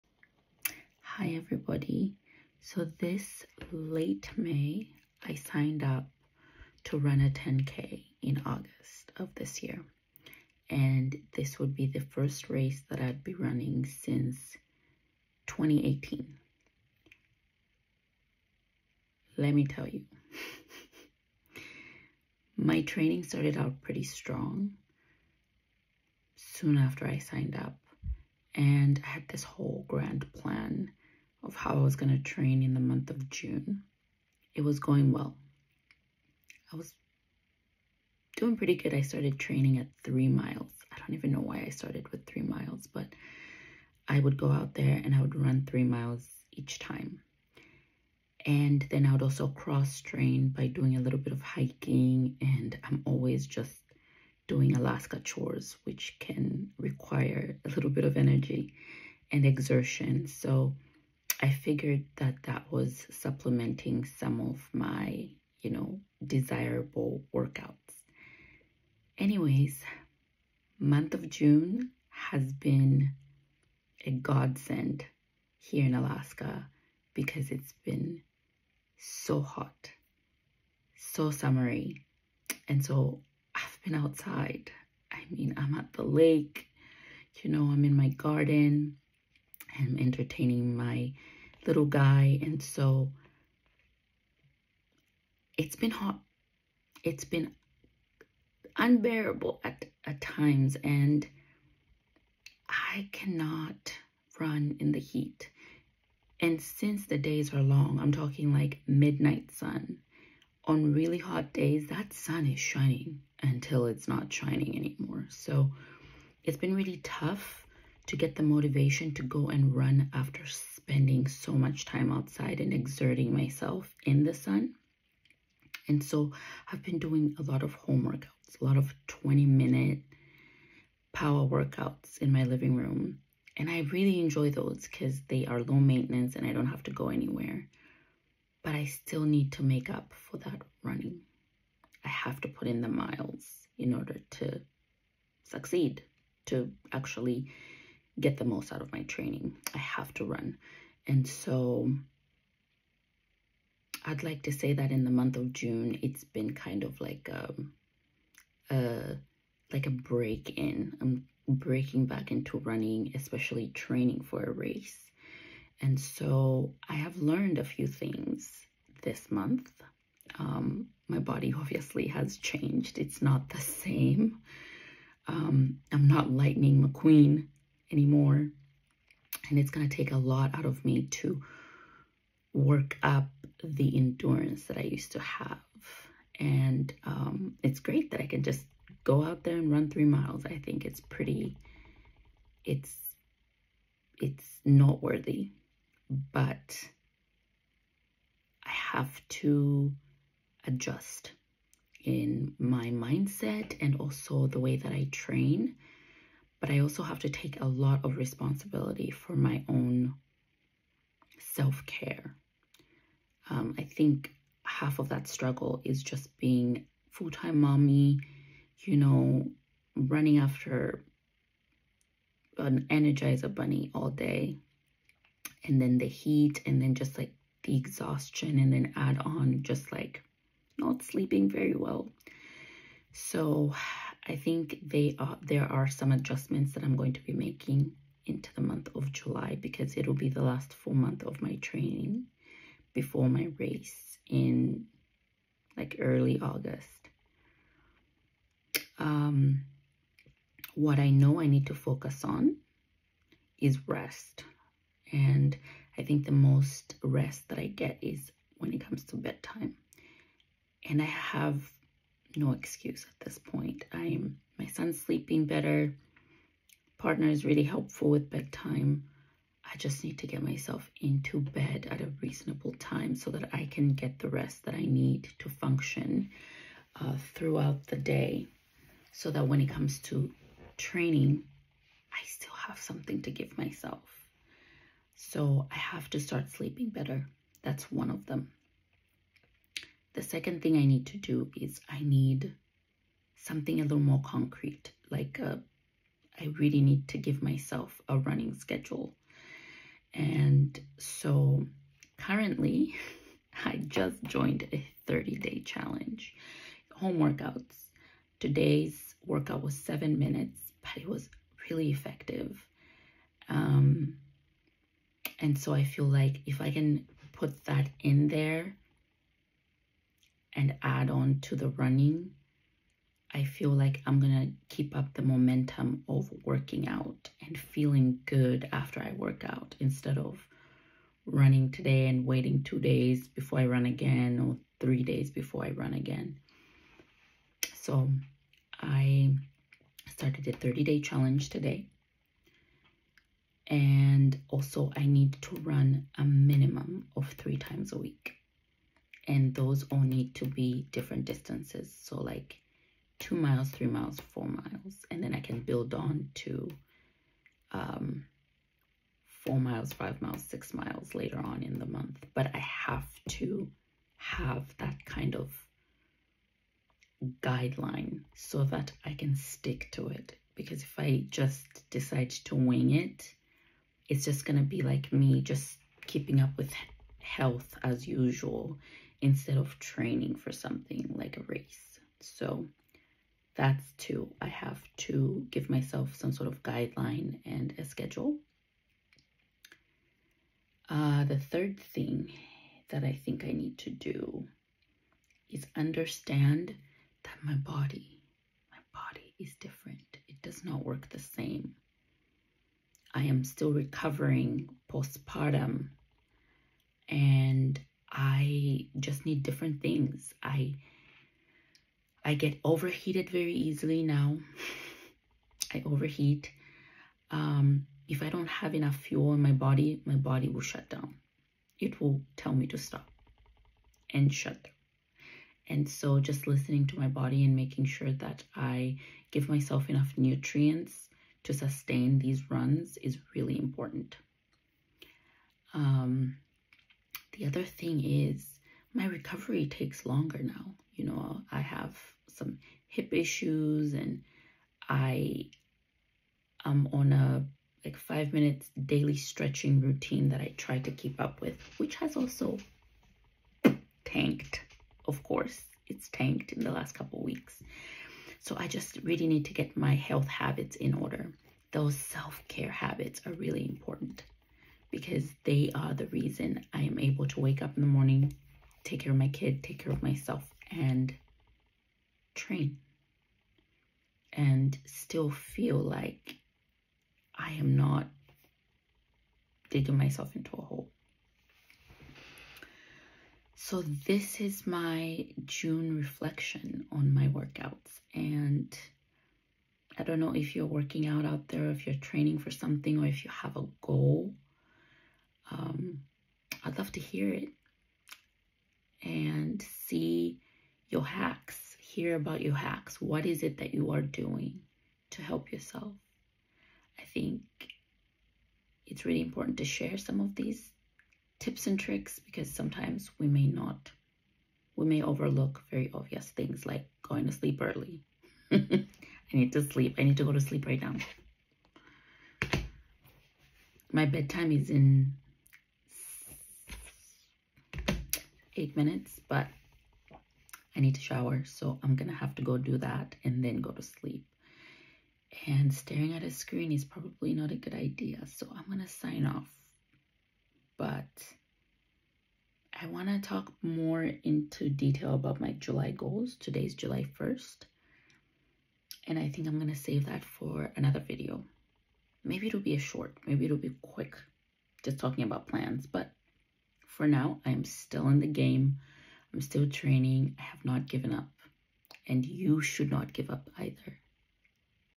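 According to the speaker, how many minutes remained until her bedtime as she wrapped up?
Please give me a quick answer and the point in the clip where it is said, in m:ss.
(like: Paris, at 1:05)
8 minutes, at 8:48.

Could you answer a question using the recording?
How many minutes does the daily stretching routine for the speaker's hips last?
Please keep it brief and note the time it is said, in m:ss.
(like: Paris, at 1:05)
5 minutes, at 7:27.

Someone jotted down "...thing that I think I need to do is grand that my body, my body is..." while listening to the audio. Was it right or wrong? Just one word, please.
wrong.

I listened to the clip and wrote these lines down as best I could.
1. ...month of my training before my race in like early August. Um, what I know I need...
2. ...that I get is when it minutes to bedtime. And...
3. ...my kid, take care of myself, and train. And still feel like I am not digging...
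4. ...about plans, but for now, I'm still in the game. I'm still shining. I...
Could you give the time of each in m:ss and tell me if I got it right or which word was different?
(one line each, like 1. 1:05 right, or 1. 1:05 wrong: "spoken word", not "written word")
1. 4:00 right
2. 4:17 wrong: "comes", not "minutes"
3. 7:49 right
4. 9:15 wrong: "training", not "shining".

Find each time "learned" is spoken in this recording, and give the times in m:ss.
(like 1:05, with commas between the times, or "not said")
2:47.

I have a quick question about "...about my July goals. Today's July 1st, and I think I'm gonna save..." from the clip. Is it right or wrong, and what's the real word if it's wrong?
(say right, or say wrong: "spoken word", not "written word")
right.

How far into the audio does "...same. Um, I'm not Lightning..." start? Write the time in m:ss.
2:53.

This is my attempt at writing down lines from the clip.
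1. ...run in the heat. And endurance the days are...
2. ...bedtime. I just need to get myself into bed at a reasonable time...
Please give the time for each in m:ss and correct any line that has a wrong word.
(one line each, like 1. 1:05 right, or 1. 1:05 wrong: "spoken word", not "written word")
1. 1:44 wrong: "since", not "endurance"
2. 4:28 right.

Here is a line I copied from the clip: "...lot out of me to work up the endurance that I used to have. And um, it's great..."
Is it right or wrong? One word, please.
right.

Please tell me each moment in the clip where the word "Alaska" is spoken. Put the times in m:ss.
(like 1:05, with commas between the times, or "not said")
0:54, 1:15.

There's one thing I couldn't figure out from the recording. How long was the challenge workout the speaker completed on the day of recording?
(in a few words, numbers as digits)
7 minutes.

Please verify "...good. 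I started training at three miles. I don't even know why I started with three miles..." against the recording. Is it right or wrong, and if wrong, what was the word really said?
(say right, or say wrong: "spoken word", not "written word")
right.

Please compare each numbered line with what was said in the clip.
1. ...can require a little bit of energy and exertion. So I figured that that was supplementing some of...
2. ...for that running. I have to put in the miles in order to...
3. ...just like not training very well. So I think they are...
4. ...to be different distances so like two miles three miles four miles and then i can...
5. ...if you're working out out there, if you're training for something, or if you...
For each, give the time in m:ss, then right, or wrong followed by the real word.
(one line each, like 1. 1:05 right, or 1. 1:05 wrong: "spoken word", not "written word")
1. 0:56 right
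2. 2:20 right
3. 3:49 wrong: "sleeping", not "training"
4. 5:50 right
5. 8:10 right.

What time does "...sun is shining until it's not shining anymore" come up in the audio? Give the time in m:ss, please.
1:52.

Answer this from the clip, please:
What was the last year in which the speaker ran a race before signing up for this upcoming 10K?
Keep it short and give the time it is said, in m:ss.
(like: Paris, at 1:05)
2018, at 0:15.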